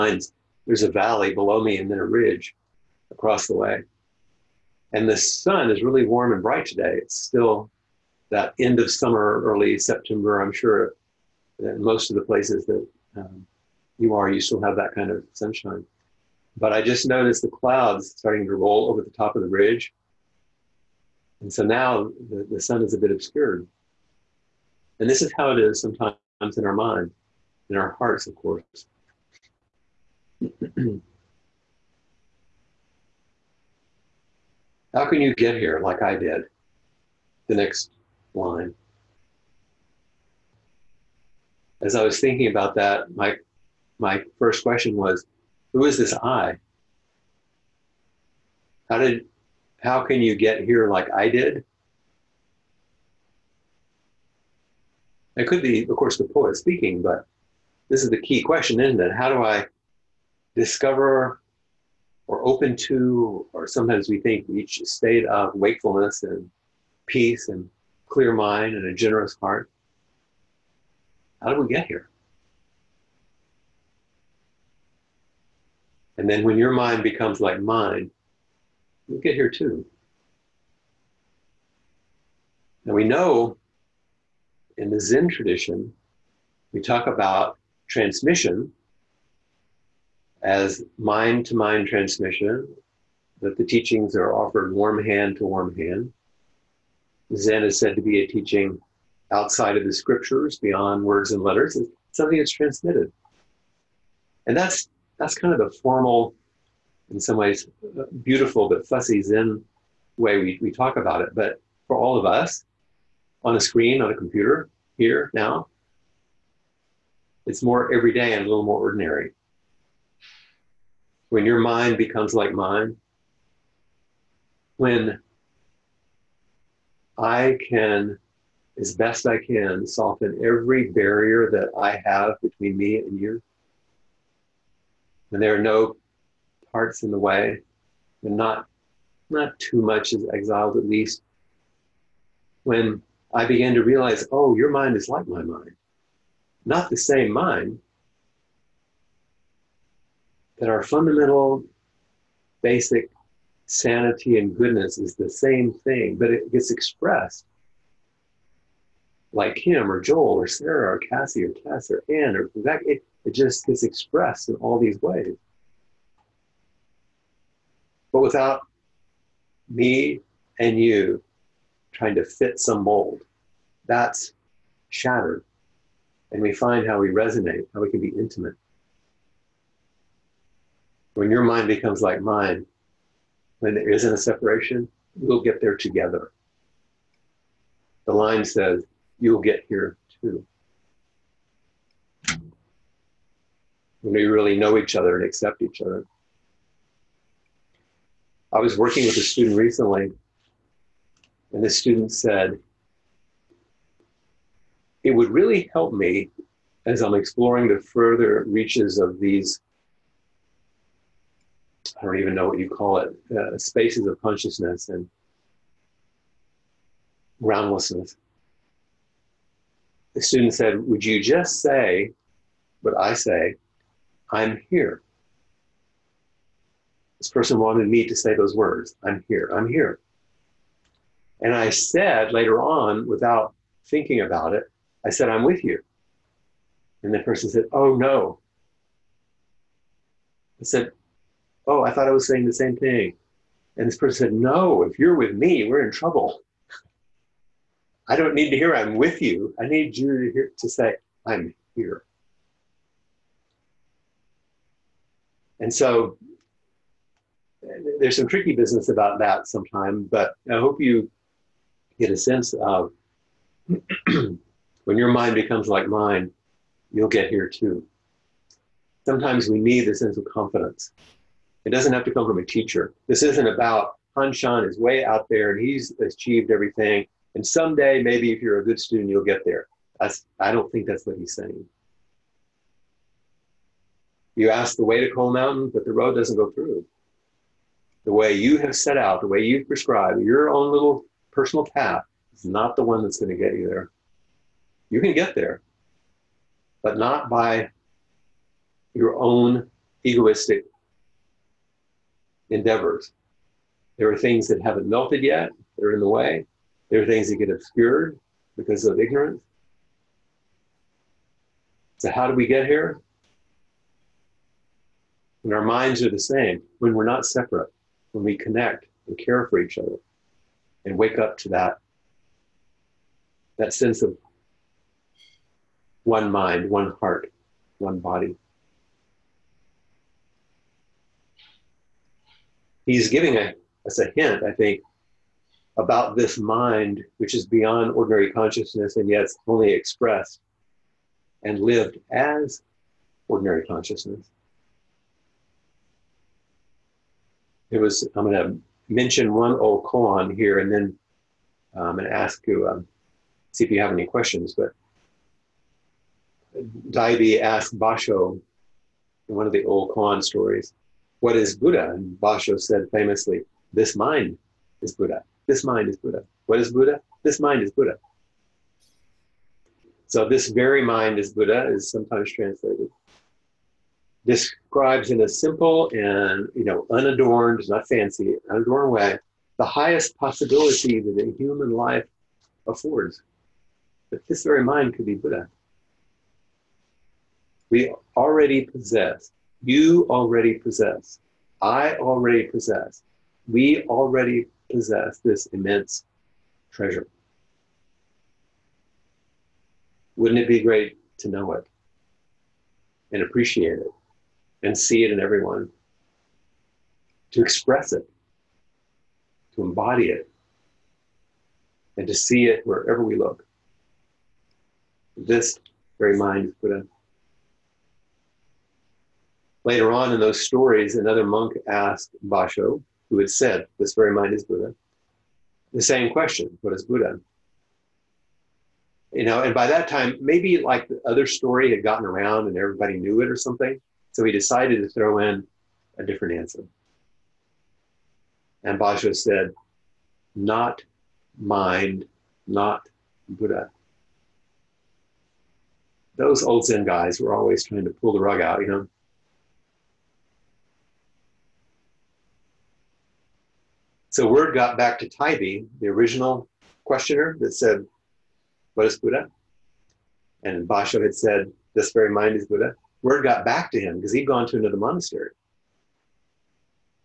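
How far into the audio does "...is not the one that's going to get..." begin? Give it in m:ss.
4:52.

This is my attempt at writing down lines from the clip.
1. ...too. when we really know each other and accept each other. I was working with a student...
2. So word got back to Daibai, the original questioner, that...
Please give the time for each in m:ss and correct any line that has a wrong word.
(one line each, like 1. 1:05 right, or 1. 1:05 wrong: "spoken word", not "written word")
1. 3:10 right
2. 7:34 right.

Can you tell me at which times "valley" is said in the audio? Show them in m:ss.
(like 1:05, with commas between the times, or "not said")
0:00.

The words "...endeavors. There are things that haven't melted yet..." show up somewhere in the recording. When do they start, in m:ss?
5:02.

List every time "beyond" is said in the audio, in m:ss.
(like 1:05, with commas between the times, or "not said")
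1:40, 5:37.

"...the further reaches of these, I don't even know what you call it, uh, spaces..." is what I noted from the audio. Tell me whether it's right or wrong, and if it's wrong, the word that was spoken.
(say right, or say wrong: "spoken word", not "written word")
right.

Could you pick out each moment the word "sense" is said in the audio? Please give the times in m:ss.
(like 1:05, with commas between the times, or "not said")
4:22, 4:29, 5:23.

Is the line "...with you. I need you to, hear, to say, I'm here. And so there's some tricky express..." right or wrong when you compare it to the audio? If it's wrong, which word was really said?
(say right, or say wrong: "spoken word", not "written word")
wrong: "business", not "express".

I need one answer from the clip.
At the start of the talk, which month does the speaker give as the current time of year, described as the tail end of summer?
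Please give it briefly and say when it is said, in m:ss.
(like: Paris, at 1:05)
early September, at 0:09.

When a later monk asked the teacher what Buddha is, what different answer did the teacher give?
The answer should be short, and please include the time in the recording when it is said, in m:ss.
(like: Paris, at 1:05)
Not mind, not Buddha, at 7:20.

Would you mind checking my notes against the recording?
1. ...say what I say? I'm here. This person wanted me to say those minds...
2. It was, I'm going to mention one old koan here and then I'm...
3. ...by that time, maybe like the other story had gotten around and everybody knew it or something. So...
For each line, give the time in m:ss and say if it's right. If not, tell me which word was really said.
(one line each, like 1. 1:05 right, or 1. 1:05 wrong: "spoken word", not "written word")
1. 3:41 wrong: "words", not "minds"
2. 5:47 right
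3. 7:09 right.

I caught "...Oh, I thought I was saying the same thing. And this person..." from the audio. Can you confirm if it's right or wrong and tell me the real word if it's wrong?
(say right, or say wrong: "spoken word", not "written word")
right.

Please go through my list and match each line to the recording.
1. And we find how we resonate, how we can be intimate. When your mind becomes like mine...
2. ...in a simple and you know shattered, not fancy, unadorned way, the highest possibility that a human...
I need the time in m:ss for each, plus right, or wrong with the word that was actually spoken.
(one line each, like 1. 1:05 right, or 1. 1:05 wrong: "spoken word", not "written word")
1. 2:56 right
2. 6:15 wrong: "unadorned", not "shattered".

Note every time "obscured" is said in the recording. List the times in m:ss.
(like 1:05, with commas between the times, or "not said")
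0:23, 5:07.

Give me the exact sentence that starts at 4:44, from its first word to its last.
You ask the way to Cold Mountain, but the road doesn't go through.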